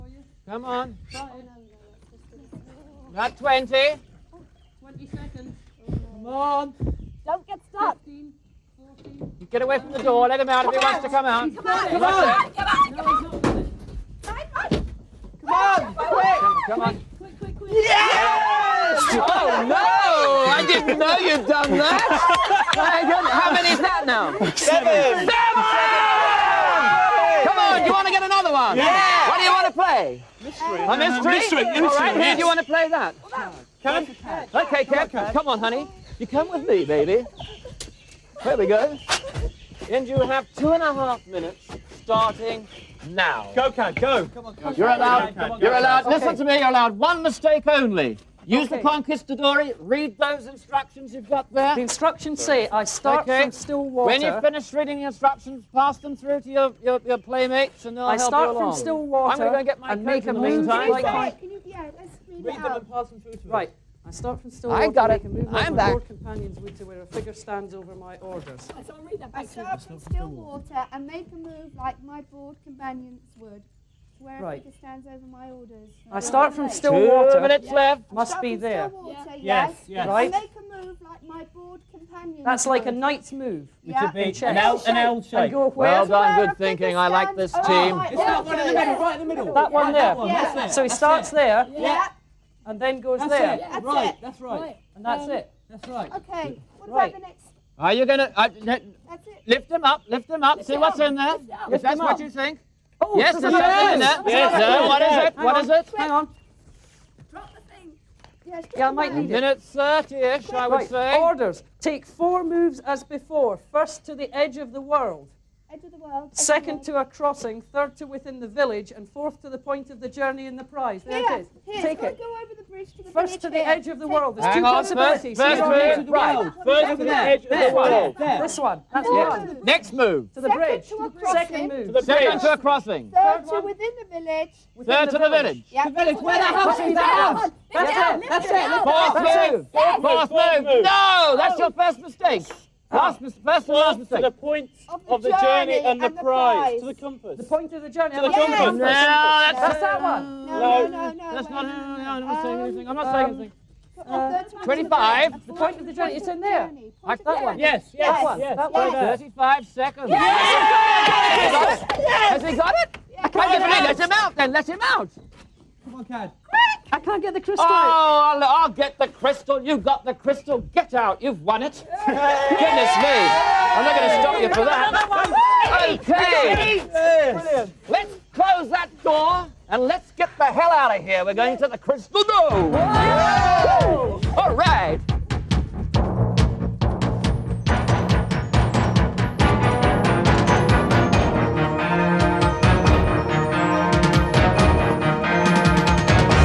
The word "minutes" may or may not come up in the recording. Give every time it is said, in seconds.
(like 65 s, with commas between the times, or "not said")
41 s, 77 s, 109 s.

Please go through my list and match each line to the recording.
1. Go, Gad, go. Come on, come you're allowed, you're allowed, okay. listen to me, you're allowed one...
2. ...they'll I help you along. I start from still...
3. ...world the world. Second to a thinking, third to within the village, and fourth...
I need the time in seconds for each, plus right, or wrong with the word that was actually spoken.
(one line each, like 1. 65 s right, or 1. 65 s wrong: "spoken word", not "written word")
1. 43 s right
2. 57 s right
3. 114 s wrong: "crossing", not "thinking".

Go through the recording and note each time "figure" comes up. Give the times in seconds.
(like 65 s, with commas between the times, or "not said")
67 s, 74 s.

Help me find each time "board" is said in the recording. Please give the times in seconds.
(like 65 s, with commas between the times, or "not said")
72 s, 81 s.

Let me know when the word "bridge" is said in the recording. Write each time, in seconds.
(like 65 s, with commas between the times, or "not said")
122 s, 130 s.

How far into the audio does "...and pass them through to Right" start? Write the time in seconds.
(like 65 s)
62 s.